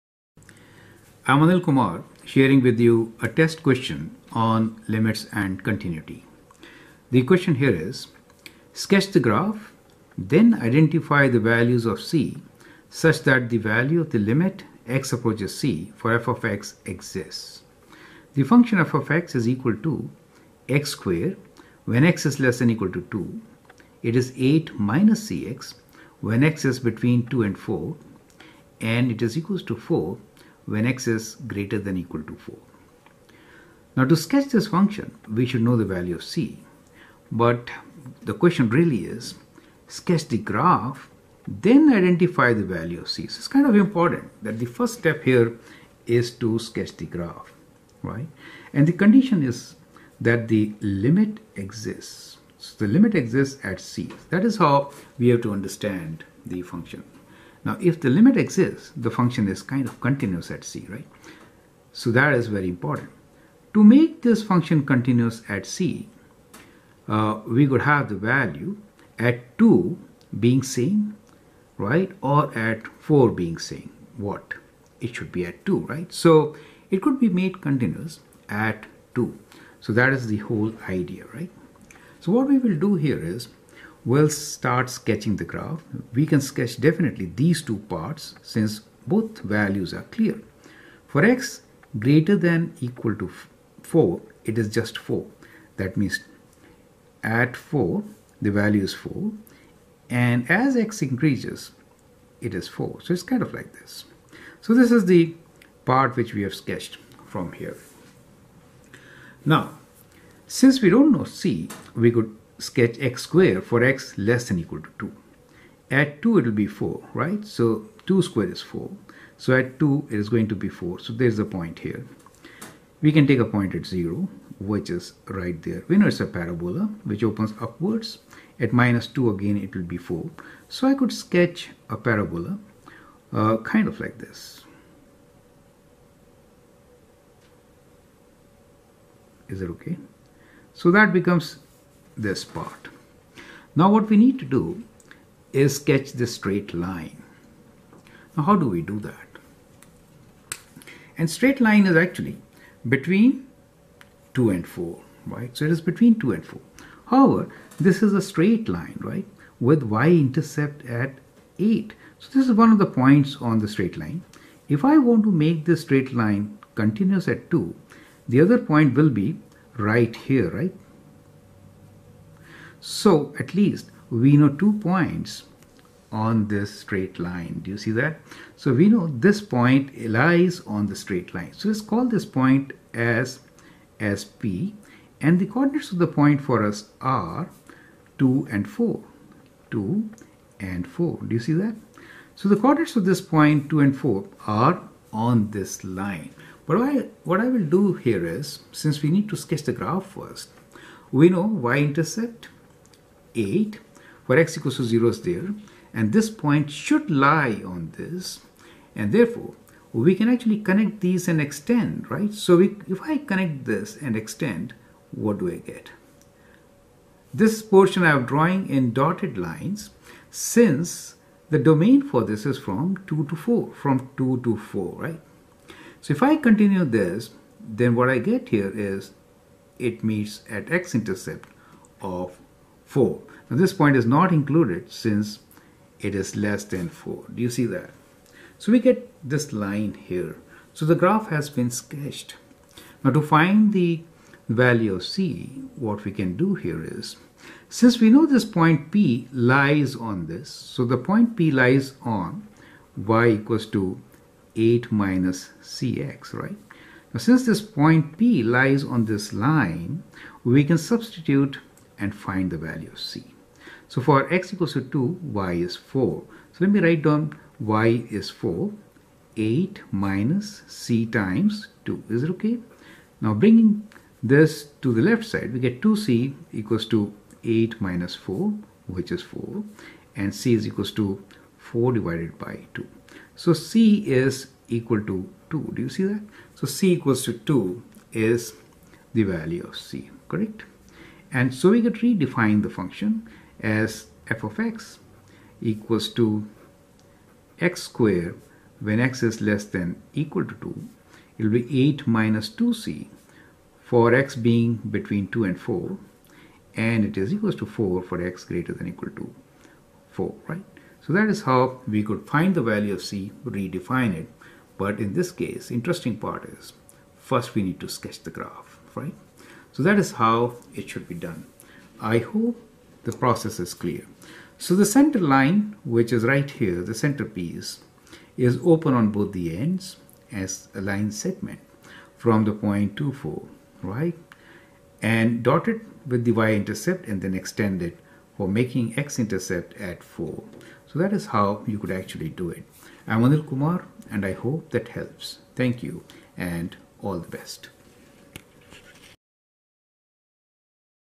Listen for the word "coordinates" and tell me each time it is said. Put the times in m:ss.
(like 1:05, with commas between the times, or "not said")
3:05, 3:12.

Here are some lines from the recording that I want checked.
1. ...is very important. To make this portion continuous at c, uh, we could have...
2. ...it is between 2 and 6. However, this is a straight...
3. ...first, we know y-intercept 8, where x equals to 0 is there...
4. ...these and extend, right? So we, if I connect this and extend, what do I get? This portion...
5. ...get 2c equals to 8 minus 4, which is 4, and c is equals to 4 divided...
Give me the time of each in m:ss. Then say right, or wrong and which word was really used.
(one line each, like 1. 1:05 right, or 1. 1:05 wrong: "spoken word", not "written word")
1. 1:02 wrong: "function", not "portion"
2. 2:35 wrong: "4", not "6"
3. 3:20 right
4. 3:31 right
5. 4:35 right.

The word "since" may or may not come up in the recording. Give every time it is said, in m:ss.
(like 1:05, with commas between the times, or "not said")
1:28, 1:50, 3:18, 3:40, 3:54, 4:07, 4:17.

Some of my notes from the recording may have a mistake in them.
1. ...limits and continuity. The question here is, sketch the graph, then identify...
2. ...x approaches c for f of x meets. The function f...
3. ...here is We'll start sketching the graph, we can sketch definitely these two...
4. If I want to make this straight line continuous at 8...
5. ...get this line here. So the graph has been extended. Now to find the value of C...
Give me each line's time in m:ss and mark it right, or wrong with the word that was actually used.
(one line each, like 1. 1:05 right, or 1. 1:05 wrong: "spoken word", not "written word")
1. 0:04 right
2. 0:14 wrong: "exists", not "meets"
3. 1:22 right
4. 2:44 wrong: "2", not "8"
5. 3:58 wrong: "sketched", not "extended".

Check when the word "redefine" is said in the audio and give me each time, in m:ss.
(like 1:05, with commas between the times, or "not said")
4:51, 5:13.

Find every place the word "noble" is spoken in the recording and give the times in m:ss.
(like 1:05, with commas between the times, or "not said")
not said.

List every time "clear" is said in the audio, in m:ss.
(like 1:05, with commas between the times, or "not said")
1:30, 5:23.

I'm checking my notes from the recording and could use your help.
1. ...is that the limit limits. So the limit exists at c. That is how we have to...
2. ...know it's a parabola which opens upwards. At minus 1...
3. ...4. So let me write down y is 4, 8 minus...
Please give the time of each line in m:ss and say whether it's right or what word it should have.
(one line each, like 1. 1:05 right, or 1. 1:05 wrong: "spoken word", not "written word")
1. 0:49 wrong: "exists", not "limits"
2. 2:05 wrong: "2", not "1"
3. 4:25 right.